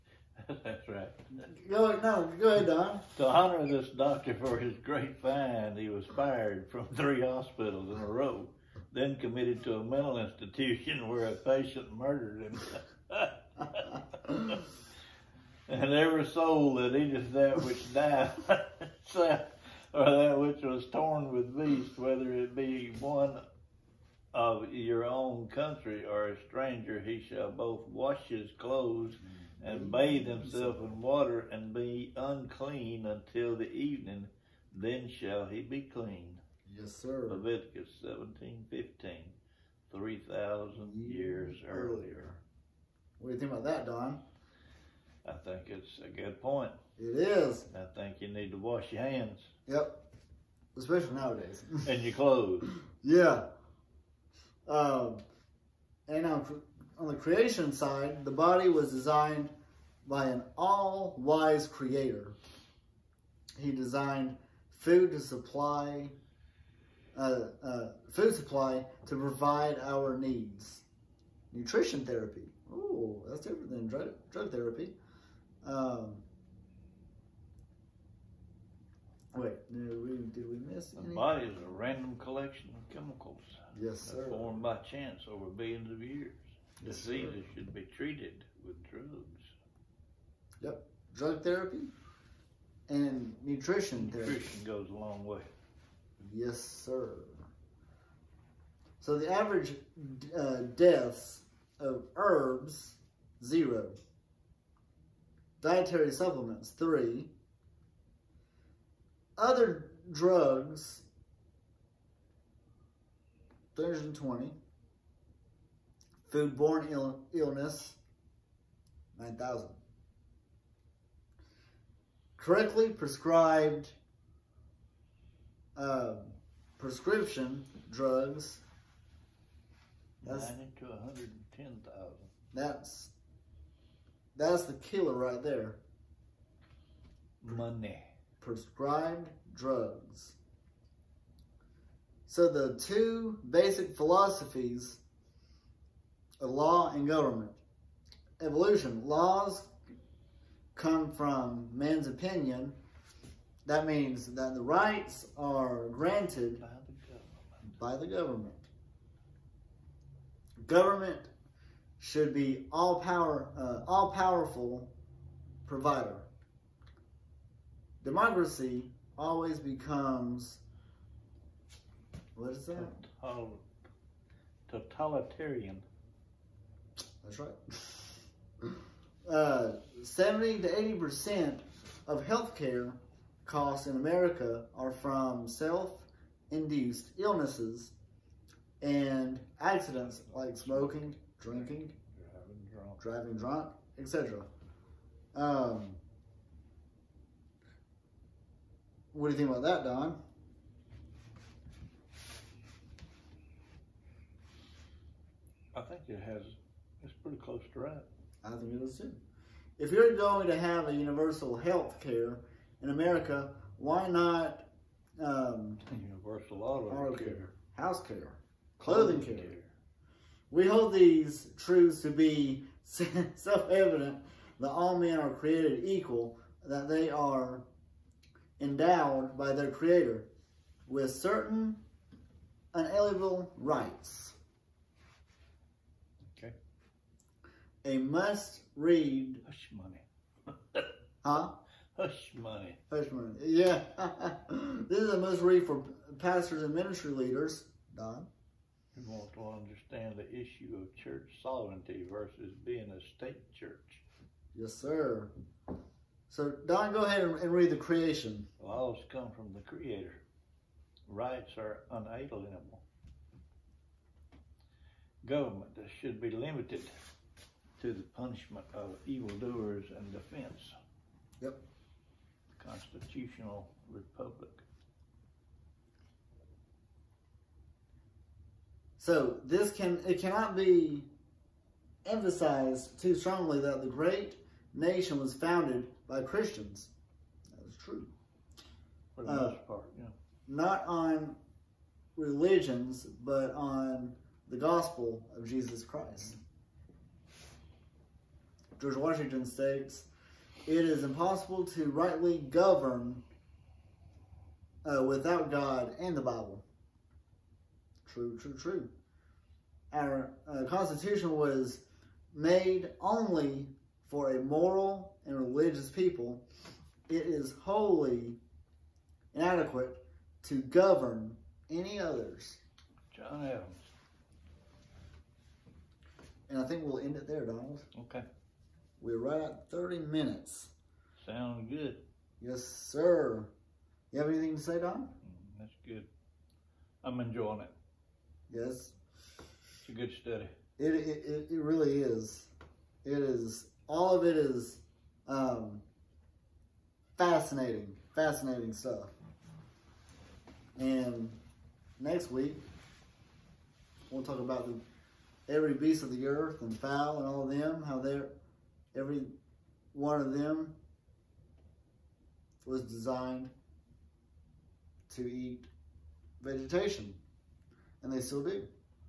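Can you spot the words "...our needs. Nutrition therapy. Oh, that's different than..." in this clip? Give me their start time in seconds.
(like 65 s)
69 s.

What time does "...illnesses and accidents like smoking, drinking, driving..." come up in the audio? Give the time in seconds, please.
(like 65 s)
187 s.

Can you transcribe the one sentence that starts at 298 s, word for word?
George Washington states, it is impossible to rightly govern uh, without God and the Bible.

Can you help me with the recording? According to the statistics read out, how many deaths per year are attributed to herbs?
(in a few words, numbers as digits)
0.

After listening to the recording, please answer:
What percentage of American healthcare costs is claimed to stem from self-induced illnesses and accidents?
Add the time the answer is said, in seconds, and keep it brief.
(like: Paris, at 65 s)
70 to 80%, at 180 s.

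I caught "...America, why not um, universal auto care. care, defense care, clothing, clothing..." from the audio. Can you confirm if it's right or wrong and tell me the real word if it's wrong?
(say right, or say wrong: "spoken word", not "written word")
wrong: "house", not "defense".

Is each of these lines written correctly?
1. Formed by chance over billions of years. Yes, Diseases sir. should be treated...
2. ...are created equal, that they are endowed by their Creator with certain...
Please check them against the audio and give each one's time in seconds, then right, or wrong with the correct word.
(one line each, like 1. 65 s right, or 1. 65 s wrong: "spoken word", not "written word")
1. 84 s right
2. 225 s right.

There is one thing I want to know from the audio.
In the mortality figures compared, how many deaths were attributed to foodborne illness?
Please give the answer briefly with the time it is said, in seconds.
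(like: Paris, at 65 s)
9,000, at 119 s.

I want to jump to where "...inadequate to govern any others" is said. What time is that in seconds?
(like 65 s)
319 s.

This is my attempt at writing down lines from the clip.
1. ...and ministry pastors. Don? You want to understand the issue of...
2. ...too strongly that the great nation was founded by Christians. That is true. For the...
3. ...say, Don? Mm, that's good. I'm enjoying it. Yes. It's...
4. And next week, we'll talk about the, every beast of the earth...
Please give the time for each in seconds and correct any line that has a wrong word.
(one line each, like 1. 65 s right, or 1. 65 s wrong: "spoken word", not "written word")
1. 246 s wrong: "leaders", not "pastors"
2. 282 s right
3. 334 s right
4. 350 s right.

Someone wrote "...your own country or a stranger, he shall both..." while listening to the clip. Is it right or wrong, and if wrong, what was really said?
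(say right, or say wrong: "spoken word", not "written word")
right.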